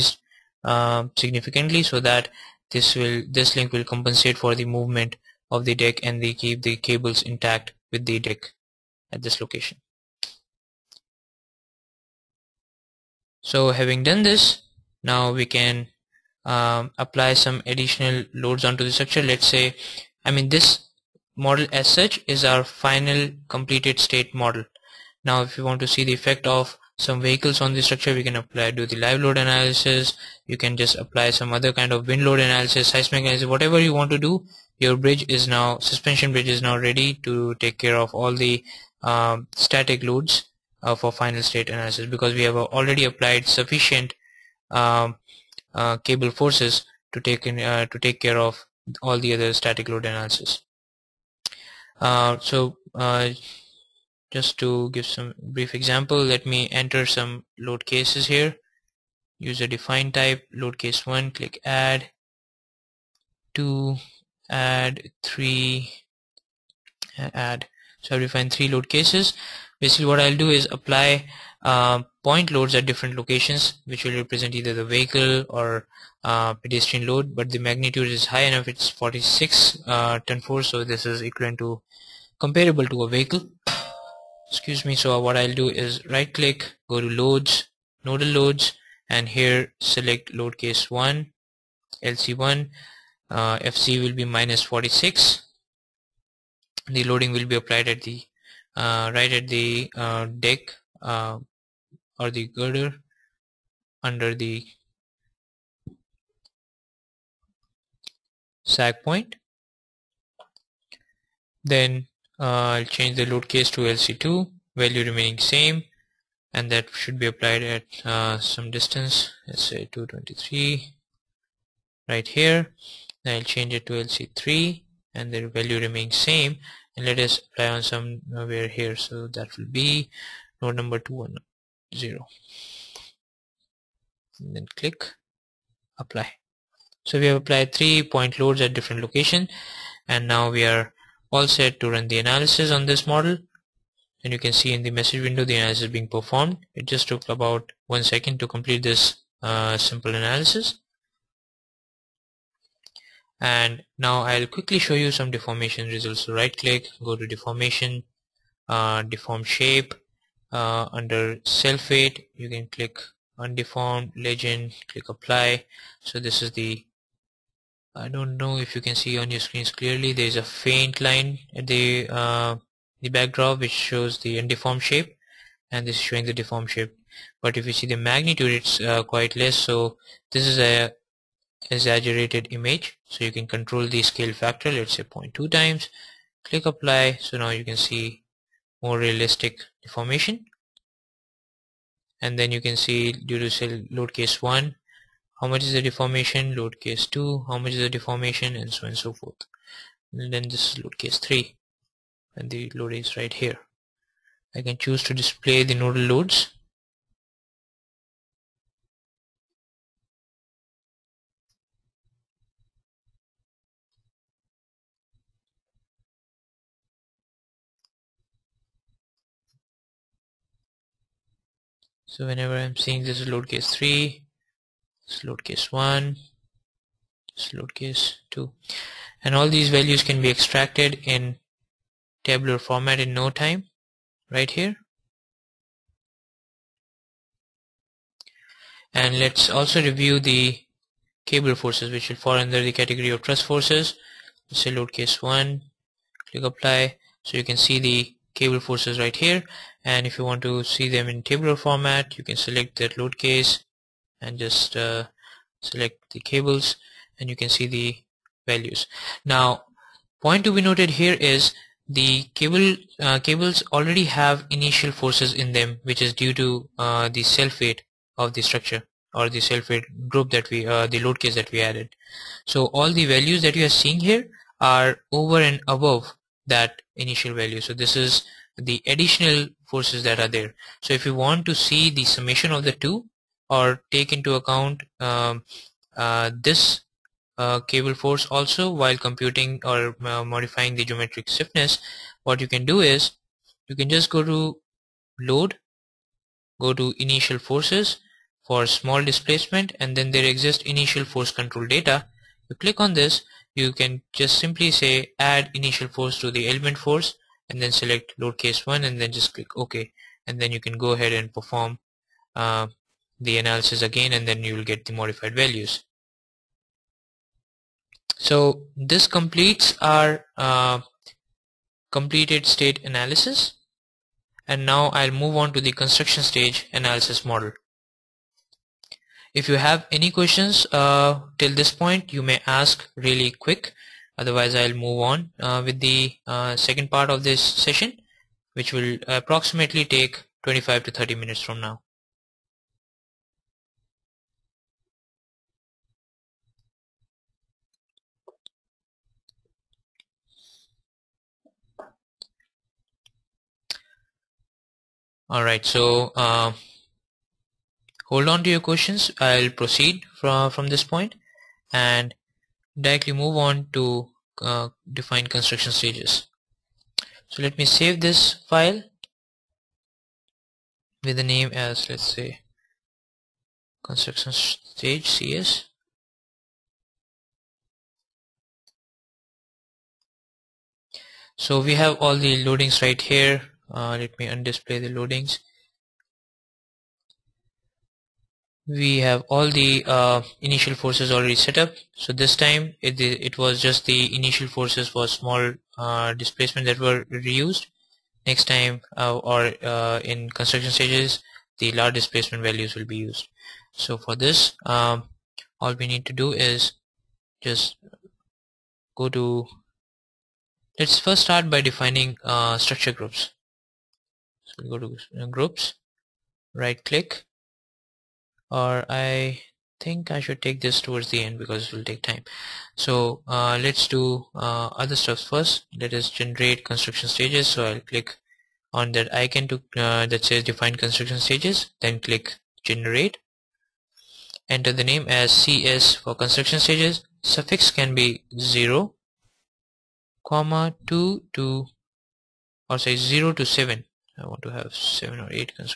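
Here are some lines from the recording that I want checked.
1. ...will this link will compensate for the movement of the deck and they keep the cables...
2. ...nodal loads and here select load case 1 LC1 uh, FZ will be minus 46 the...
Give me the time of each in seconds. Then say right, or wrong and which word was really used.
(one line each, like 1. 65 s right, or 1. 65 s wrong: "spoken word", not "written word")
1. 2 s right
2. 88 s right.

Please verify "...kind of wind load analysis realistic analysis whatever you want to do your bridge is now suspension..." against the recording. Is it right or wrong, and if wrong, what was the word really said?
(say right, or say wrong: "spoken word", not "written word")
wrong: "seismic", not "realistic".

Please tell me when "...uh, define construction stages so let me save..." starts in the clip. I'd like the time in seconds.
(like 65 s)
364 s.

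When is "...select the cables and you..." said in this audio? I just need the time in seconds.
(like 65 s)
255 s.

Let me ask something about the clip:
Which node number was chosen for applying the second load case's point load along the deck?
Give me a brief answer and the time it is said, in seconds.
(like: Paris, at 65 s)
223, at 119 s.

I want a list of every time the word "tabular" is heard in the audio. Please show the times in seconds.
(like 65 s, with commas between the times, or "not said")
232 s, 251 s.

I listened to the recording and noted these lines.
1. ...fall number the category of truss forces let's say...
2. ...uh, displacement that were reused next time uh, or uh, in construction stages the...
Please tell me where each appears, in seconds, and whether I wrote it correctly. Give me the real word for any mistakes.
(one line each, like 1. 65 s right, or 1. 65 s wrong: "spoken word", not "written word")
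1. 242 s wrong: "under", not "number"
2. 395 s right.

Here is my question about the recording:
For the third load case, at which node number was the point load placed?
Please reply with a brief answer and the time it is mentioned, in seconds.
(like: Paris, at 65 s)
210, at 130 s.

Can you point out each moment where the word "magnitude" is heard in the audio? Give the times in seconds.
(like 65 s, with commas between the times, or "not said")
77 s, 177 s.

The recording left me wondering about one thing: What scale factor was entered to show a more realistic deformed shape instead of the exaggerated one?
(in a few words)
0.2.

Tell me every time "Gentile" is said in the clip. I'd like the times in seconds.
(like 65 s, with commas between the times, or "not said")
not said.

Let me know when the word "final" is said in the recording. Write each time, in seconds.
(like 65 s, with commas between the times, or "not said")
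22 s, 41 s.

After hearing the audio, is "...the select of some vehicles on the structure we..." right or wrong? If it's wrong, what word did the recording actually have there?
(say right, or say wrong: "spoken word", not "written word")
wrong: "effect", not "select".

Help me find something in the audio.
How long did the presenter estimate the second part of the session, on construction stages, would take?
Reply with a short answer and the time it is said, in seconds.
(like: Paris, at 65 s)
25 to 30 minutes, at 340 s.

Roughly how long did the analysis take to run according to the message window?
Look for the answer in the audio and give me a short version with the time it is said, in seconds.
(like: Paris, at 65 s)
one second, at 147 s.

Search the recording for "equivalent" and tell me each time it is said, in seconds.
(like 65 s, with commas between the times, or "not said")
81 s.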